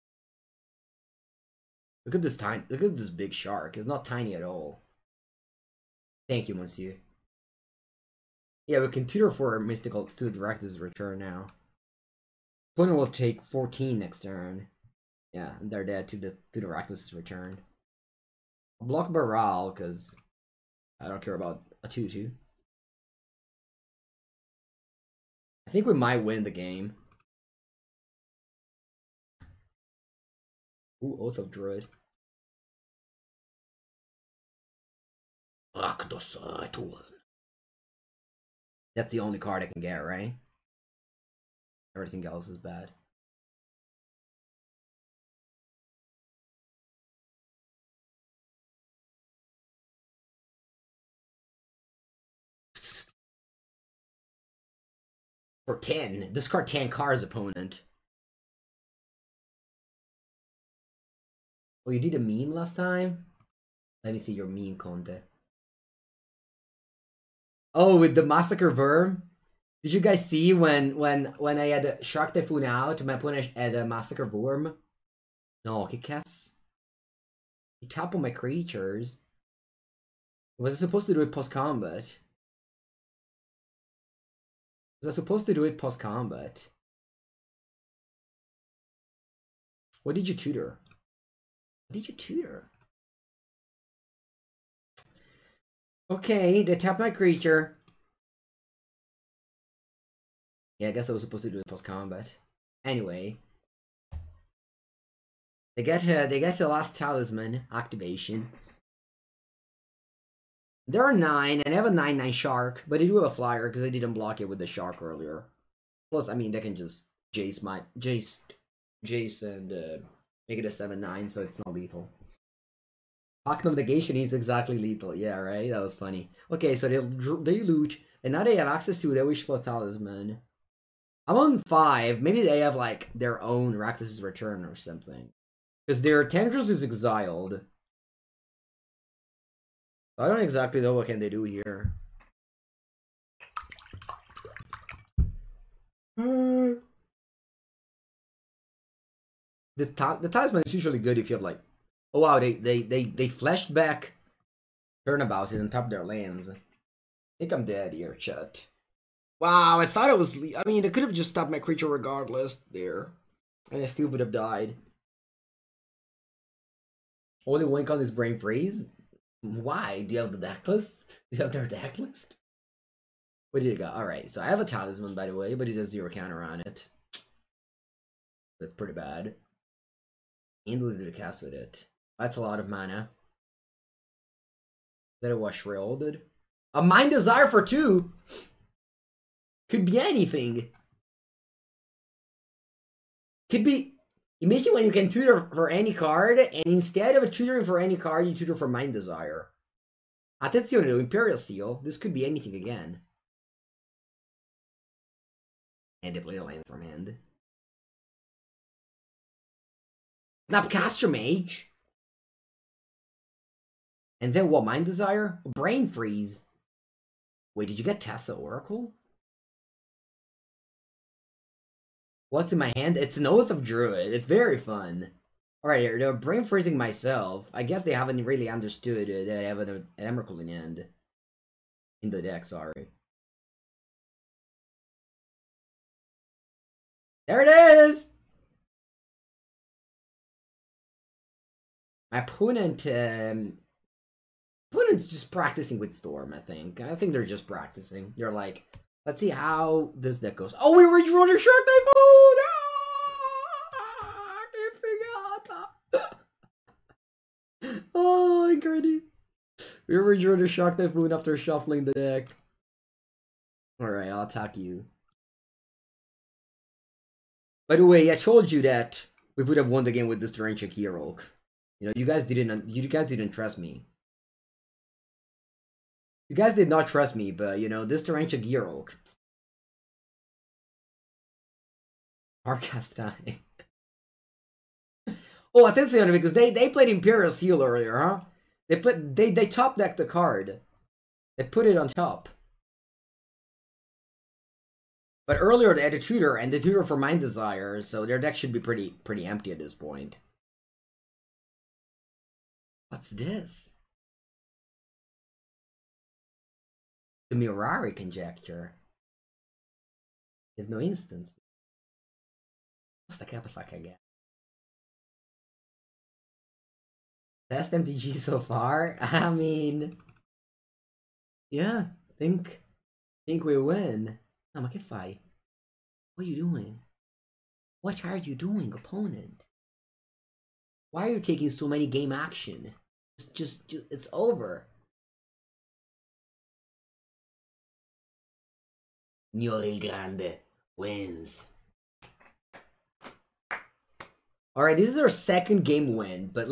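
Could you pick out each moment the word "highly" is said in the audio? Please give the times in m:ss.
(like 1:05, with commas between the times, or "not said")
not said.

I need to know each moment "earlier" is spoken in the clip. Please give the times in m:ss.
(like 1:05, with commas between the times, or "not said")
1:55, 4:47, 4:55.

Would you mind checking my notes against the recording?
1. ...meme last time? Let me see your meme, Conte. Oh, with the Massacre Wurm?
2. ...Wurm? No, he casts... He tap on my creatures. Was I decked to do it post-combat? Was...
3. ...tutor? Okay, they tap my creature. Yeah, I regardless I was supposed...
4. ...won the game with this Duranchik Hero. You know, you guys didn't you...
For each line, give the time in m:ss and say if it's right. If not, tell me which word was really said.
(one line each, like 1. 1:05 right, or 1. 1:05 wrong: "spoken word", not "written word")
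1. 1:02 right
2. 1:14 wrong: "supposed", not "decked"
3. 1:32 wrong: "guess", not "regardless"
4. 4:29 right.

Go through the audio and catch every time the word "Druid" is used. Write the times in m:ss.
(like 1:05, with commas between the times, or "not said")
0:31, 3:43.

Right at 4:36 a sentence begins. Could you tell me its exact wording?
You guys did not trust me, but you know, this Torrential Gearhulk.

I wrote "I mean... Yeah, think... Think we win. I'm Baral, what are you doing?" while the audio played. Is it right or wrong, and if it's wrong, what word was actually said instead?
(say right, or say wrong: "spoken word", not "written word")
wrong: "Namakifai", not "Baral".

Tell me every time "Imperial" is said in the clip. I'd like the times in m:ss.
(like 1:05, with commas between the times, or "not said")
3:20, 4:46.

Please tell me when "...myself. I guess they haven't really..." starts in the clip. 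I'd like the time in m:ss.
3:46.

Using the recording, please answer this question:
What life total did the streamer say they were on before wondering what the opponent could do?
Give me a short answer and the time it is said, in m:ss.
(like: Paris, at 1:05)
5, at 2:11.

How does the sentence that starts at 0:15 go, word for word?
Yeah, they're dead to the to the Rakdos's return.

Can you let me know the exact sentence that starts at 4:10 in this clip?
Oh, we redraw the shark knife food!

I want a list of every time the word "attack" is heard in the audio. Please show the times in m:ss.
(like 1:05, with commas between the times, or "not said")
4:24.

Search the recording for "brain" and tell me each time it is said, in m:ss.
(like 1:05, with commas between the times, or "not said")
2:48, 3:35, 3:46.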